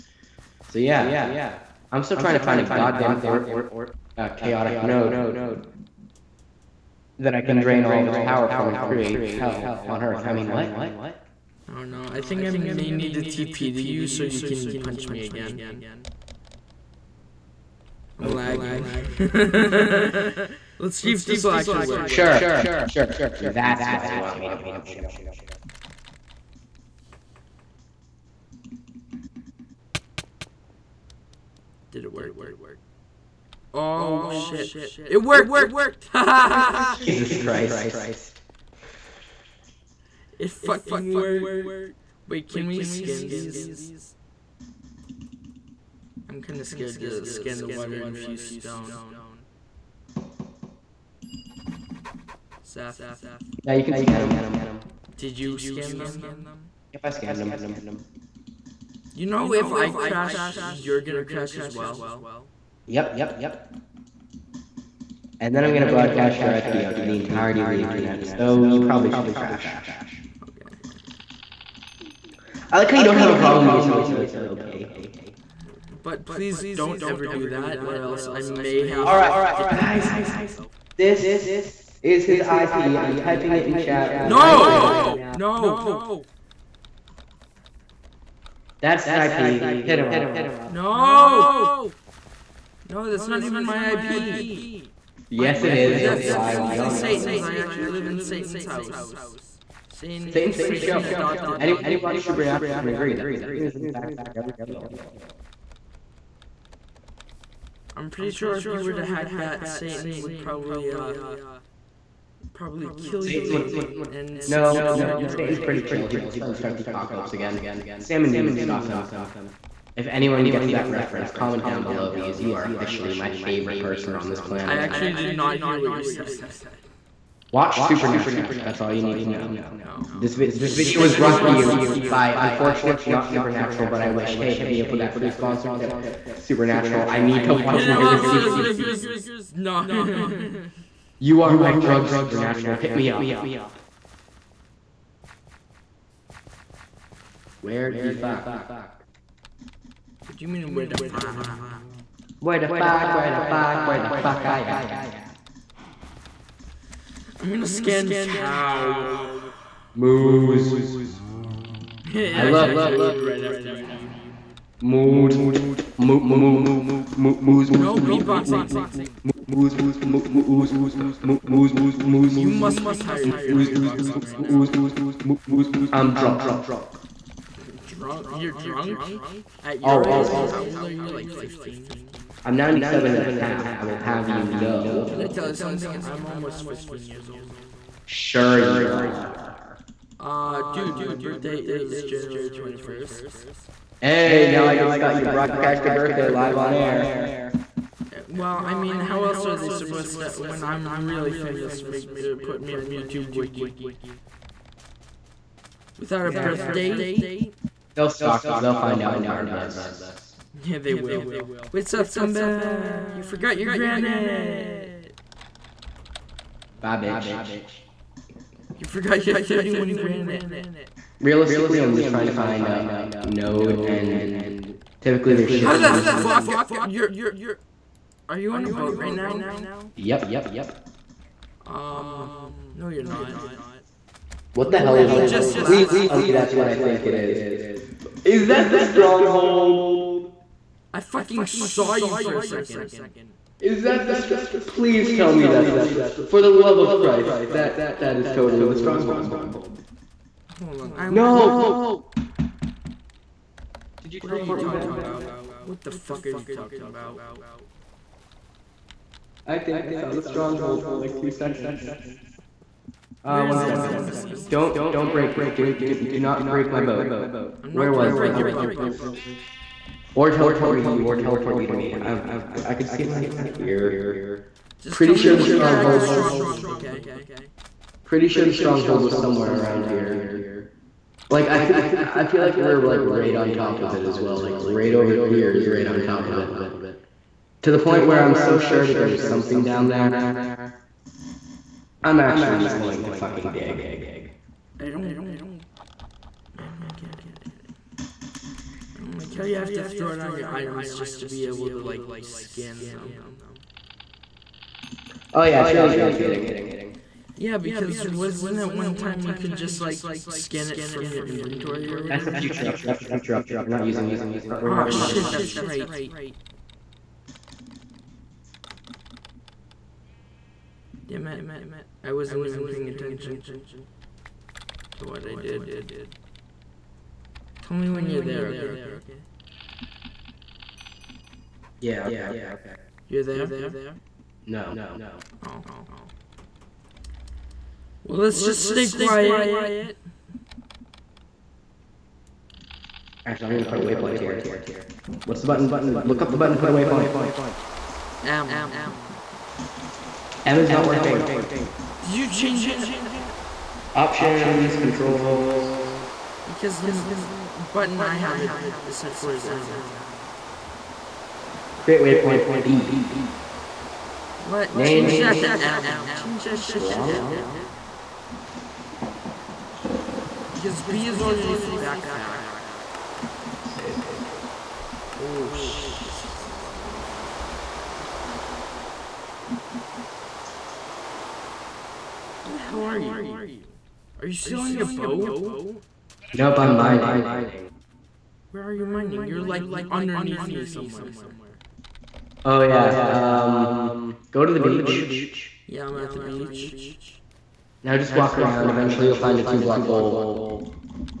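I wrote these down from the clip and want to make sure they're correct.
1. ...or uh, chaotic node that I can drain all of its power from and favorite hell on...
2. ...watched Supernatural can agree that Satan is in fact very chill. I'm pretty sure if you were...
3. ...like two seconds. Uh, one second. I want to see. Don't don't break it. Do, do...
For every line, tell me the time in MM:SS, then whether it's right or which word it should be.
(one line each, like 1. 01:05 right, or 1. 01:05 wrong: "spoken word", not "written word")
1. 00:03 wrong: "create", not "favorite"
2. 01:42 right
3. 04:20 right.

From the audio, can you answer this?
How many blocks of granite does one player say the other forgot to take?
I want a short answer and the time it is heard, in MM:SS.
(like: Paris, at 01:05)
31, at 03:39.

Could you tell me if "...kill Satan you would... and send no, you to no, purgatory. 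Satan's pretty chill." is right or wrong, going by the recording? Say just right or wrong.
right.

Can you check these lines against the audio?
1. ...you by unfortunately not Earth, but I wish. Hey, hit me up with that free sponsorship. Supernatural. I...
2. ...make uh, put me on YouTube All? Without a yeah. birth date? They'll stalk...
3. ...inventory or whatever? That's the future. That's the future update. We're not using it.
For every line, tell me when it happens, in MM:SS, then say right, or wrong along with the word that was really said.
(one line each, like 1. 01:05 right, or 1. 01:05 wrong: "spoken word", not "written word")
1. 02:11 wrong: "Supernatural", not "Earth"
2. 03:21 wrong: "Wiki", not "All"
3. 05:11 right.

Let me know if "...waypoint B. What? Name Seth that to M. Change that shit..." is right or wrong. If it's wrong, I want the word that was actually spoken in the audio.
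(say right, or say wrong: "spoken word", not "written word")
wrong: "Change", not "Seth".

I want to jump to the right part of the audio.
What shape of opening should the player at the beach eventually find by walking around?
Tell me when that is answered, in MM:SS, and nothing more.
06:39.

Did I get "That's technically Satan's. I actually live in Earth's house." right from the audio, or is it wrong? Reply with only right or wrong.
wrong.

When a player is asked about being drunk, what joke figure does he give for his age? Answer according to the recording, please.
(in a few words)
97 and a half.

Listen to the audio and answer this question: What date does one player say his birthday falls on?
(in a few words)
January 21st.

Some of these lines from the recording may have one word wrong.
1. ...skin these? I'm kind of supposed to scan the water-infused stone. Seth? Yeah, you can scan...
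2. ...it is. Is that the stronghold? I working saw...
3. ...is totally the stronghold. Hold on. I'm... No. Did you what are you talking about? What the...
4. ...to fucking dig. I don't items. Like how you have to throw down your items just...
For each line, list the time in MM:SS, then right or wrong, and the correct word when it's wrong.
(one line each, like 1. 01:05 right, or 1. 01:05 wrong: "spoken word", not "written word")
1. 00:42 wrong: "scared", not "supposed"
2. 03:57 wrong: "fucking", not "working"
3. 04:08 right
4. 04:53 right.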